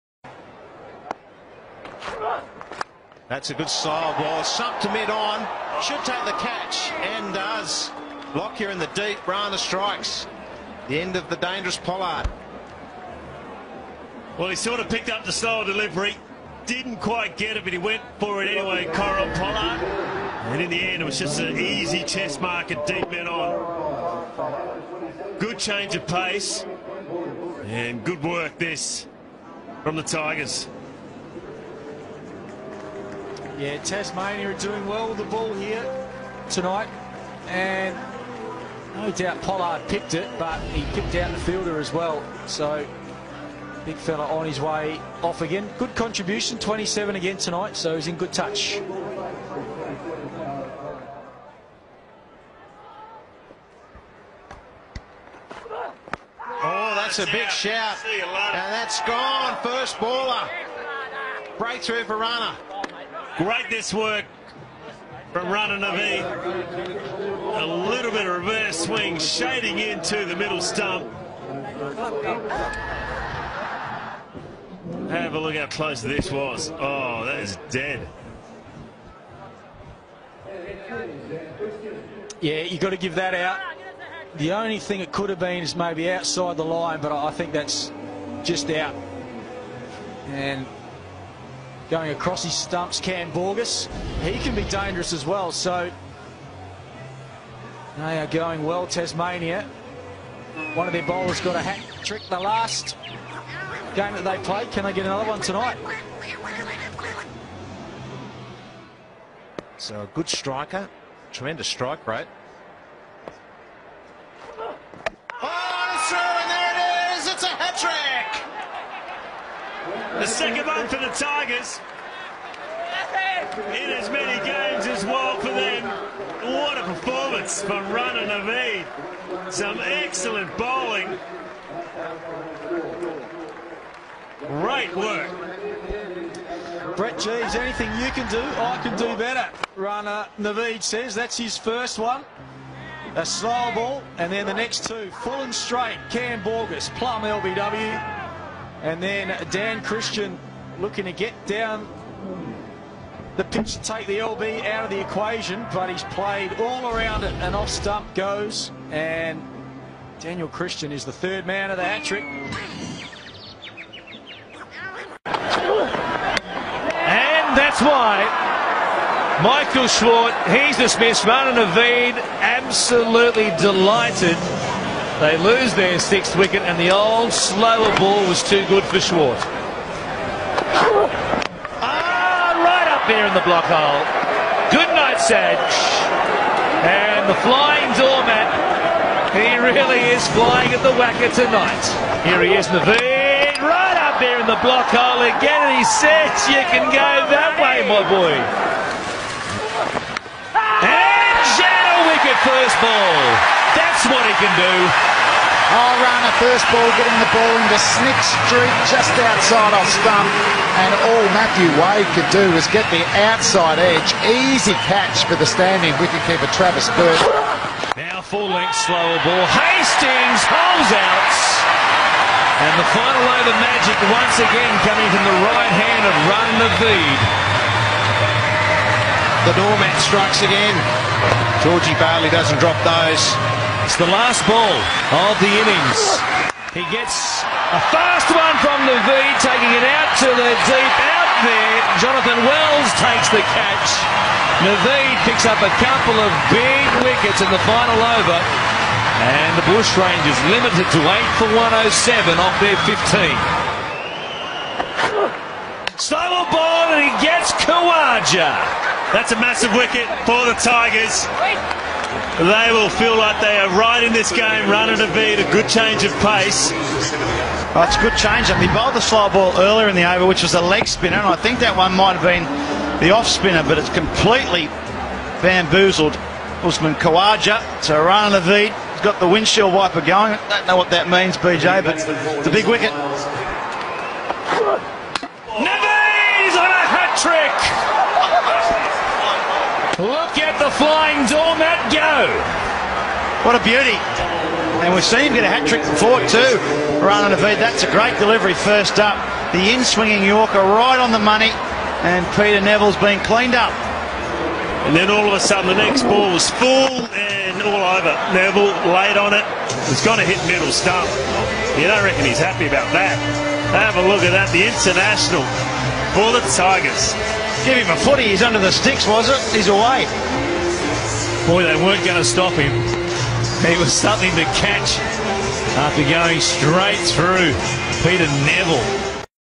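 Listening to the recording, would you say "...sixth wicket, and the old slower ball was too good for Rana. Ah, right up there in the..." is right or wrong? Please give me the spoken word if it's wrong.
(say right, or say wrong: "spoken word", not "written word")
wrong: "Swart", not "Rana".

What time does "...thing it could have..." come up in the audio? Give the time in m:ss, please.
1:24.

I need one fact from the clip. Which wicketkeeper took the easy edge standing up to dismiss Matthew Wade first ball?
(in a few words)
Travis Birt.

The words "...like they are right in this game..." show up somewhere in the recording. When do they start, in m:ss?
4:23.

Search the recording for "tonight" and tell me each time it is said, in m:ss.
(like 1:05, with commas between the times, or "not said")
0:36, 0:47, 1:45, 3:11.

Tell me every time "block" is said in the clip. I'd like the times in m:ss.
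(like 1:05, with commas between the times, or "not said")
3:03, 3:14.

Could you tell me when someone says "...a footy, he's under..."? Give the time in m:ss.
5:17.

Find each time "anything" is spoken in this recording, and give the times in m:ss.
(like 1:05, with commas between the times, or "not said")
2:17.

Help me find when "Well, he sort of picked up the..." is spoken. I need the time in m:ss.
0:14.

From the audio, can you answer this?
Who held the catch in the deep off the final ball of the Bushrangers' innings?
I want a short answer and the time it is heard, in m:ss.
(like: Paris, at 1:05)
Jonathan Wells, at 4:01.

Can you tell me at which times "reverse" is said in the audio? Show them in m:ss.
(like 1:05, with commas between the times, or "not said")
1:08.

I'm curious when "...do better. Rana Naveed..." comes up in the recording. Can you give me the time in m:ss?
2:18.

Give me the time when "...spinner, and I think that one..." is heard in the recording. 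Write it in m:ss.
4:30.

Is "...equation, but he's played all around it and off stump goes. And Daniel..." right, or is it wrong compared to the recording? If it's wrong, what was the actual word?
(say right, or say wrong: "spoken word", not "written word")
right.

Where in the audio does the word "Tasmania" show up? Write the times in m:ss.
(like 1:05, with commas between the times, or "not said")
0:33, 1:38.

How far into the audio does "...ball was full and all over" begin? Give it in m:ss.
5:06.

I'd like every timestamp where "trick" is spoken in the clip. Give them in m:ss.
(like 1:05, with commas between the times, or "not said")
1:42, 2:42, 4:47, 4:55.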